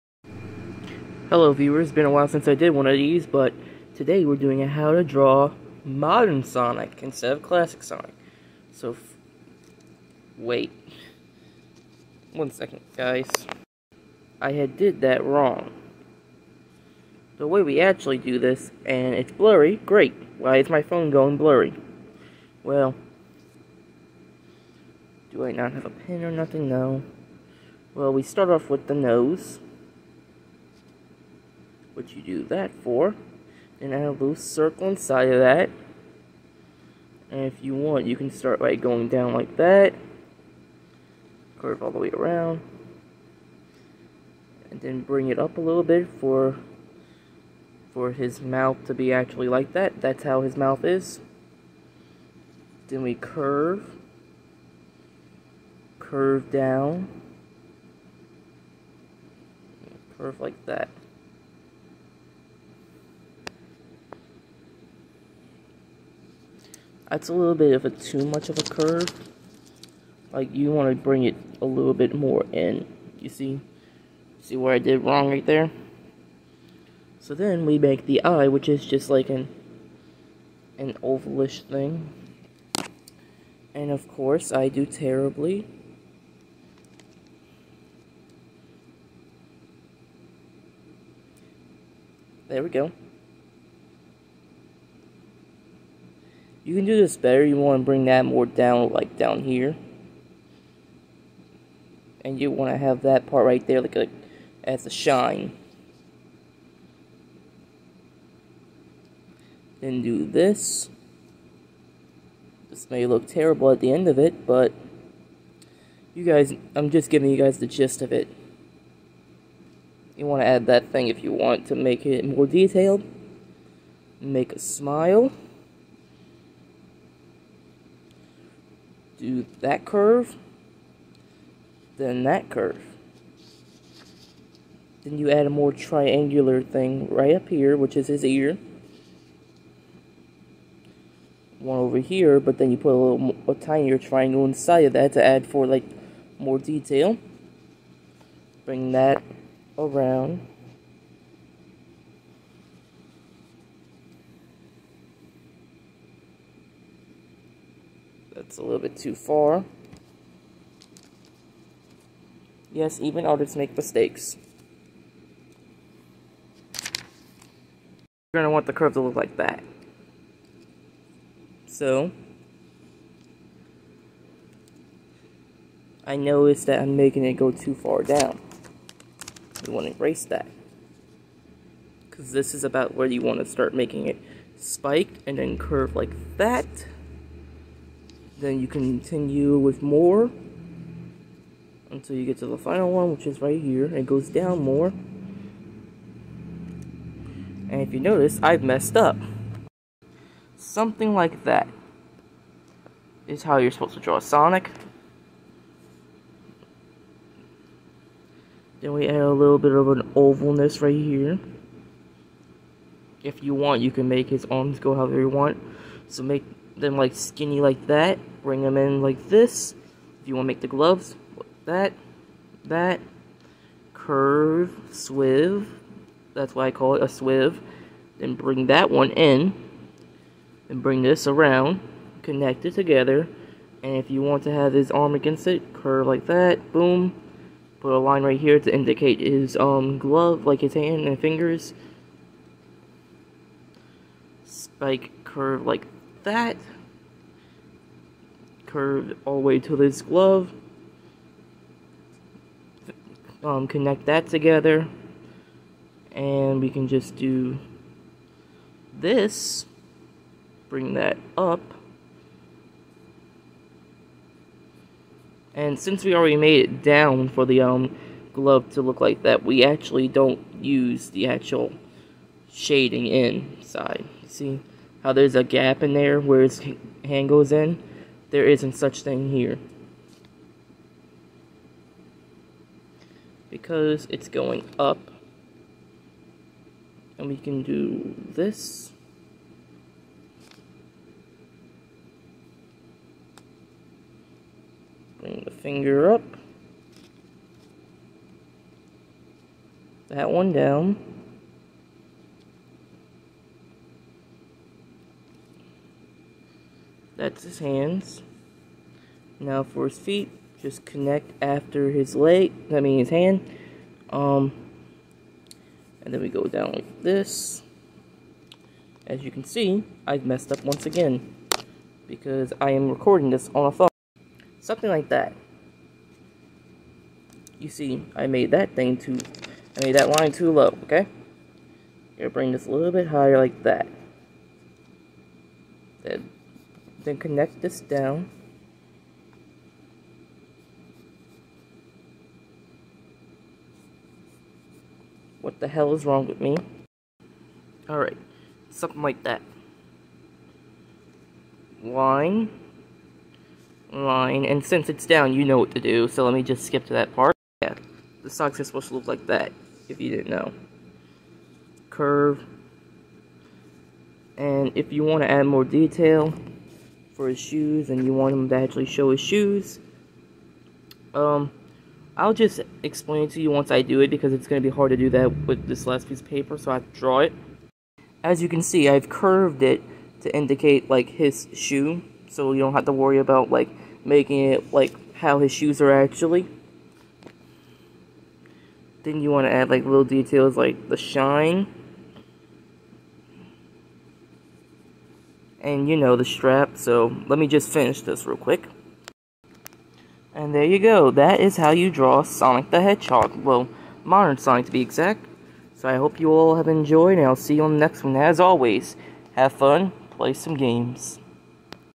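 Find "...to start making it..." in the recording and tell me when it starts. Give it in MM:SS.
03:03.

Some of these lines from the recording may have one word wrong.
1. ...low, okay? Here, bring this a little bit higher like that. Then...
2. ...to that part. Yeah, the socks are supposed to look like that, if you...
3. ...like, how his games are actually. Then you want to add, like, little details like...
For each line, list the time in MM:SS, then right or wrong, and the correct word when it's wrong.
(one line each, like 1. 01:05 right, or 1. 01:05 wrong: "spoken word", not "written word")
1. 05:30 right
2. 05:56 right
3. 06:24 wrong: "shoes", not "games".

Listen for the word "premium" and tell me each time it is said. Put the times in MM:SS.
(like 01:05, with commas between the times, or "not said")
not said.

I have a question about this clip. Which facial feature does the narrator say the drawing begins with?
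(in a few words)
The nose.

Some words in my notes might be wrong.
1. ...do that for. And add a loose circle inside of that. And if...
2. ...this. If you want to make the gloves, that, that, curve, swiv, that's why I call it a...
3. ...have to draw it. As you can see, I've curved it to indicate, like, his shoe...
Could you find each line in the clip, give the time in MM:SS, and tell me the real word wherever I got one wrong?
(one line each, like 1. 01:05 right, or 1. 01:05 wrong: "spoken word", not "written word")
1. 00:32 right
2. 03:39 right
3. 06:16 right.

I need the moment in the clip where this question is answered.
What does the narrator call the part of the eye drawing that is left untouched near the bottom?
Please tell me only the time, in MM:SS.
01:44.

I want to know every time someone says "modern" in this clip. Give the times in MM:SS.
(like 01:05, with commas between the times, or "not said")
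00:05, 06:44.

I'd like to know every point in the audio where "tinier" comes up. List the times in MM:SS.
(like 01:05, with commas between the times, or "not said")
02:23.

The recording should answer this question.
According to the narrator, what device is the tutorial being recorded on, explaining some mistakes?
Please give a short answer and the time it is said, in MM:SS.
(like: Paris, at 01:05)
A phone, at 05:23.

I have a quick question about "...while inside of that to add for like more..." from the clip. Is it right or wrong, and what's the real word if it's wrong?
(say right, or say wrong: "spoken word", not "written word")
wrong: "triangle", not "while".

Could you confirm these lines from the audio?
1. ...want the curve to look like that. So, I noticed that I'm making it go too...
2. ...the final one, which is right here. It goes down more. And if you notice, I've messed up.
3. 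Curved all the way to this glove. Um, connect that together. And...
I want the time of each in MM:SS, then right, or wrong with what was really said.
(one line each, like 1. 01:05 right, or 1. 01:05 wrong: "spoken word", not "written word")
1. 02:48 right
2. 03:12 right
3. 04:08 right.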